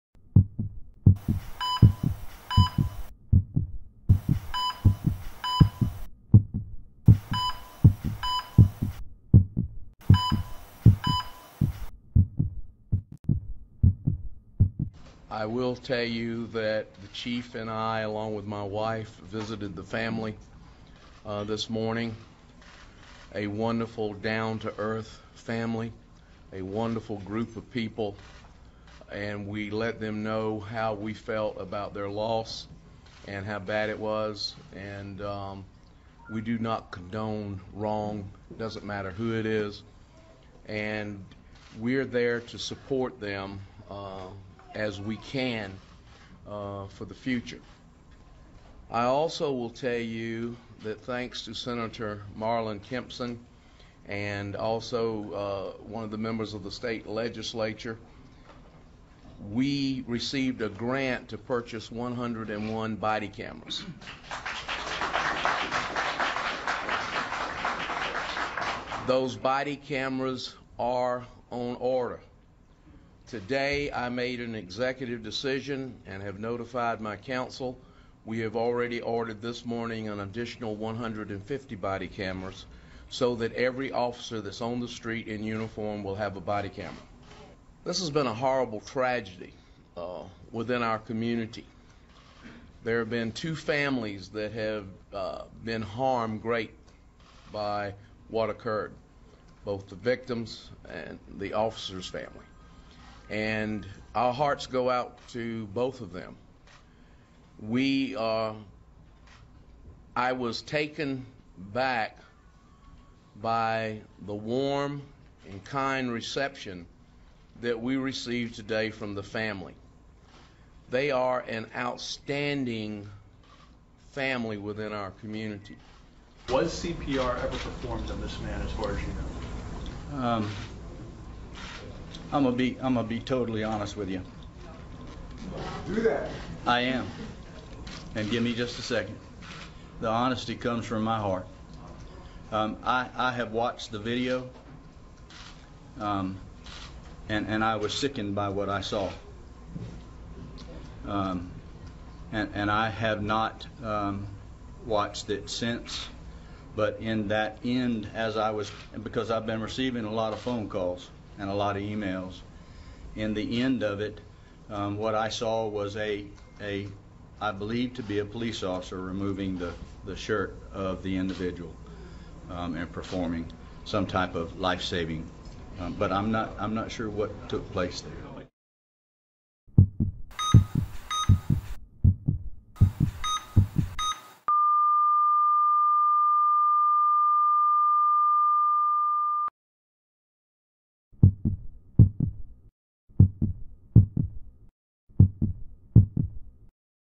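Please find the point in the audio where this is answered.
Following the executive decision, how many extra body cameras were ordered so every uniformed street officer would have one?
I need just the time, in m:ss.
1:20.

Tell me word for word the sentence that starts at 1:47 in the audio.
We, uh, I was taken back by the warm and kind reception that we received today from the family.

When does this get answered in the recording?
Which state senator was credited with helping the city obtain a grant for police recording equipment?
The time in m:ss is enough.
0:52.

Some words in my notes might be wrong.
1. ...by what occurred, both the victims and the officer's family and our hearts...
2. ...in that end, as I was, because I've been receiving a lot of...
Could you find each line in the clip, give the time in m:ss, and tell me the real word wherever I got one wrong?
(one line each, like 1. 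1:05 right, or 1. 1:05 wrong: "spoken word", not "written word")
1. 1:37 right
2. 2:37 right.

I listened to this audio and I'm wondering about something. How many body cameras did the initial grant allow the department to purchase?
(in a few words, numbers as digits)
101.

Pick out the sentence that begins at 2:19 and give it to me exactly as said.
The honesty comes from my heart.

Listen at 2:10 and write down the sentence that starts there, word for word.
Um, I'm gonna be I'm gonna be totally honest with you.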